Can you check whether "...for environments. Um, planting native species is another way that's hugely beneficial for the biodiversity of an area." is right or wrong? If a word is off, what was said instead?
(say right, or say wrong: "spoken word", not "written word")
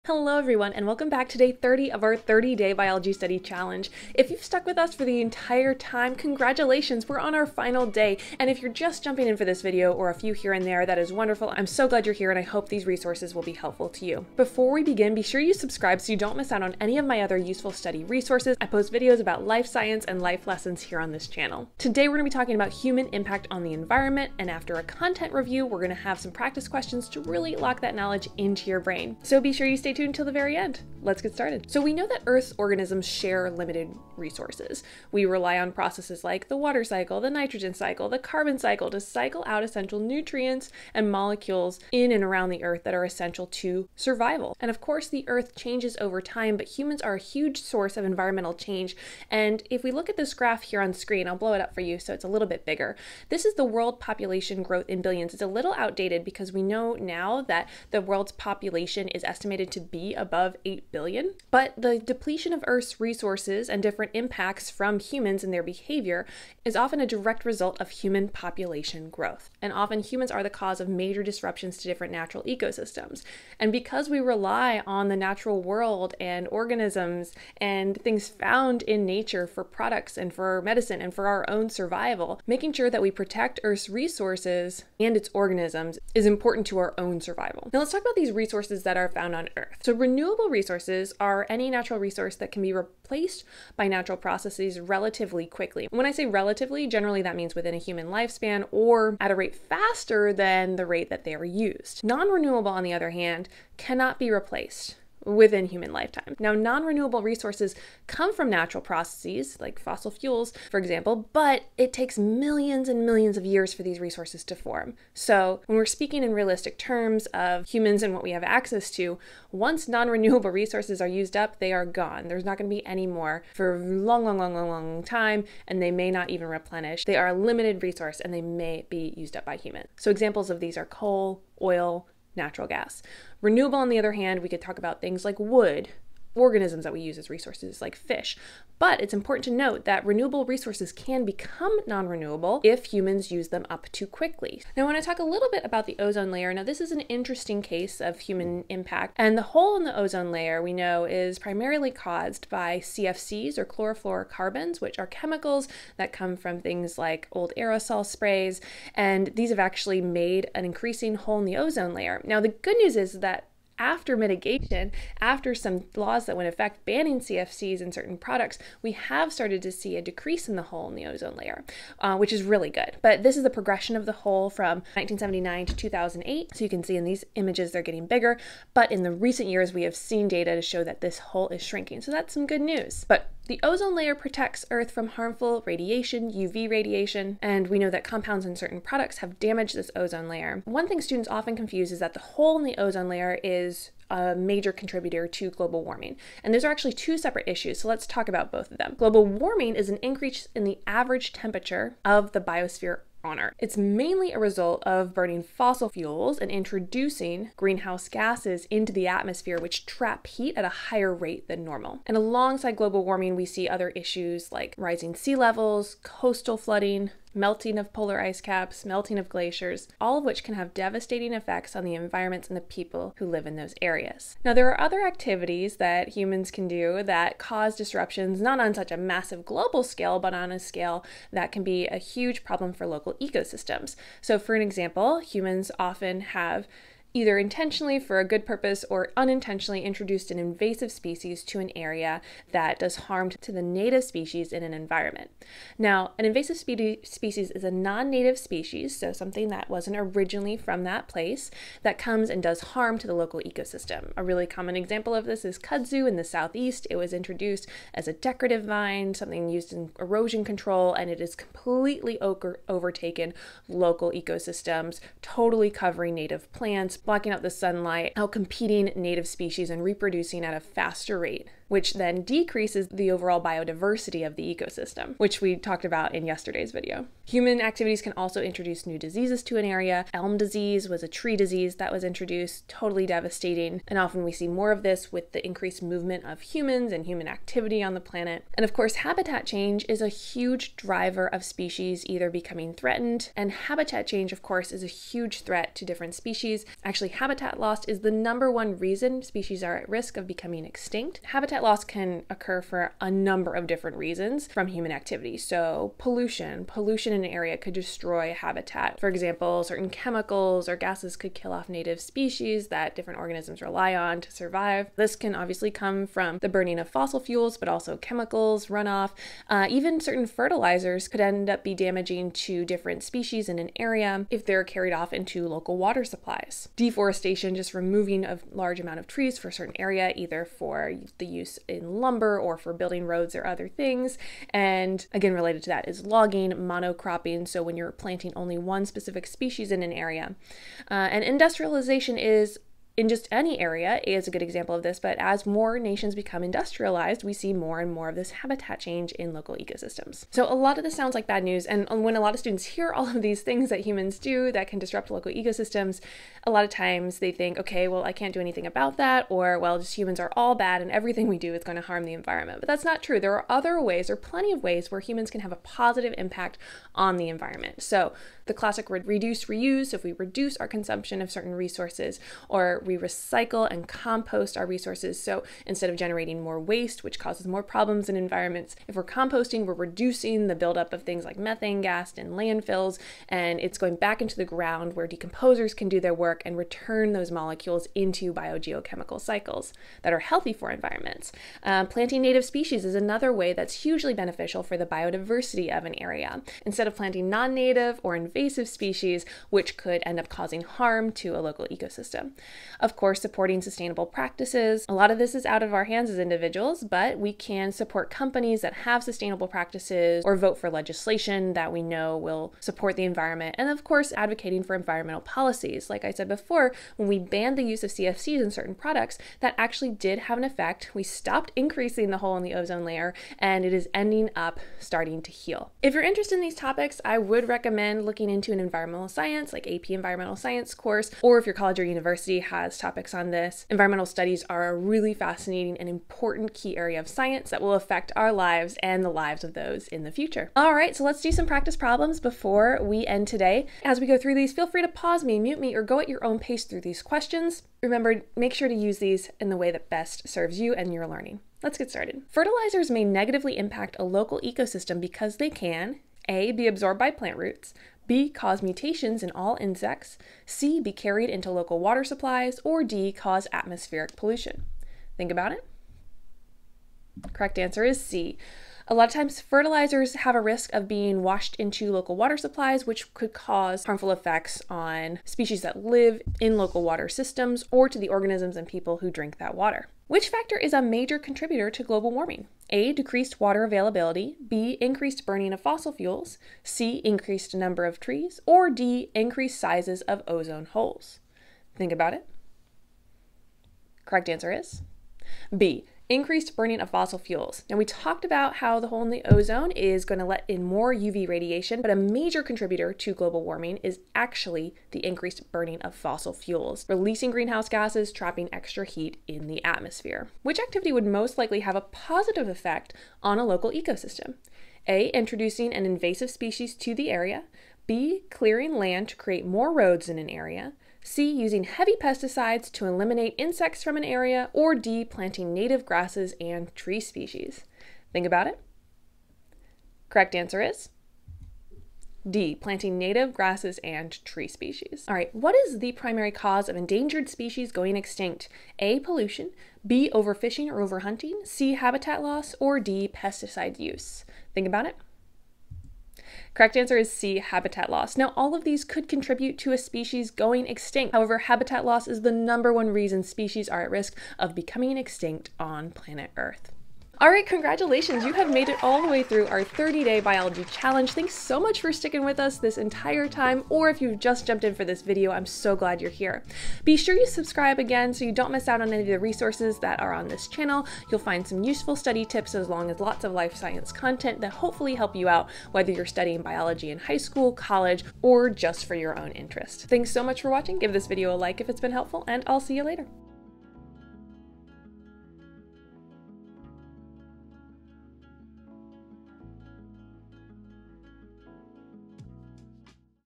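right.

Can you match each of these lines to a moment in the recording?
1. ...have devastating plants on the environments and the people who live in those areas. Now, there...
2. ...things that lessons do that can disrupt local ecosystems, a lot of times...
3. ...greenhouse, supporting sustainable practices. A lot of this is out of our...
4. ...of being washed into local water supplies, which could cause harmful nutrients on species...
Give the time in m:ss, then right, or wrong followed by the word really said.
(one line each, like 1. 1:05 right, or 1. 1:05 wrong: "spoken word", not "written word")
1. 3:40 wrong: "effects", not "plants"
2. 5:53 wrong: "humans", not "lessons"
3. 6:42 wrong: "course", not "greenhouse"
4. 7:50 wrong: "effects", not "nutrients".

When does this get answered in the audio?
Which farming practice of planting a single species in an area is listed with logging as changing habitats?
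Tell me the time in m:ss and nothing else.
5:36.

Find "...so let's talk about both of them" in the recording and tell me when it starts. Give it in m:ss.
3:17.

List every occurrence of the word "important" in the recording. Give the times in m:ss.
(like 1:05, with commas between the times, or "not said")
1:26, 2:19, 7:15.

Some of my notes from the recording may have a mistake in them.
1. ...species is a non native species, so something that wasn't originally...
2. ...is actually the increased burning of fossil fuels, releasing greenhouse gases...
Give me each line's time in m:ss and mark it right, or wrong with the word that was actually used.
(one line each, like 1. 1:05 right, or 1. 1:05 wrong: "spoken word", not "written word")
1. 4:07 right
2. 8:23 right.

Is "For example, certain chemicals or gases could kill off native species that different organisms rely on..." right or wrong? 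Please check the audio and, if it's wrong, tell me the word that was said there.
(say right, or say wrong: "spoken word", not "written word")
right.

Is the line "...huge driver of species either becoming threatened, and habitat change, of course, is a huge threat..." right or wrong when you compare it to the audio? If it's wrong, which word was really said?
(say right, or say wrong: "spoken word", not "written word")
right.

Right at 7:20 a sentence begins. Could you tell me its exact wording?
All right, so let's do some practice problems before we end today.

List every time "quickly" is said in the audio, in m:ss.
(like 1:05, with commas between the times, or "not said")
1:35, 2:24.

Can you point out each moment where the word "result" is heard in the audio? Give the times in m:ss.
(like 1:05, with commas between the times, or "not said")
1:07, 3:24.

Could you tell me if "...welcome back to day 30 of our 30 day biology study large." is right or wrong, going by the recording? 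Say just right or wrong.
wrong.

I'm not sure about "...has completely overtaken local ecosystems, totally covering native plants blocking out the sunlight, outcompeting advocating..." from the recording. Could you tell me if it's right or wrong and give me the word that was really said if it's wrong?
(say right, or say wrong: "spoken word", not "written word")
wrong: "competing", not "advocating".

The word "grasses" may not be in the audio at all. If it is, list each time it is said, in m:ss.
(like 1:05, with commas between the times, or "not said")
8:45, 8:53.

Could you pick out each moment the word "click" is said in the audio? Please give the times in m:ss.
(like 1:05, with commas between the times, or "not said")
not said.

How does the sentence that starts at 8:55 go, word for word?
All right, what is the primary cause of endangered species going extinct?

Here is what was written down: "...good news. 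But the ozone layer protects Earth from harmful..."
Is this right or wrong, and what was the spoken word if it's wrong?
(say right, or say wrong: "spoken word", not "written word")
right.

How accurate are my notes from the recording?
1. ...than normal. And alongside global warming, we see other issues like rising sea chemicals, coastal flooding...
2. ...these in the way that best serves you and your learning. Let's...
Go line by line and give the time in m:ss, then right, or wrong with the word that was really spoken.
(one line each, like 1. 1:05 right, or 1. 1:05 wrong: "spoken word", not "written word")
1. 3:31 wrong: "levels", not "chemicals"
2. 7:28 right.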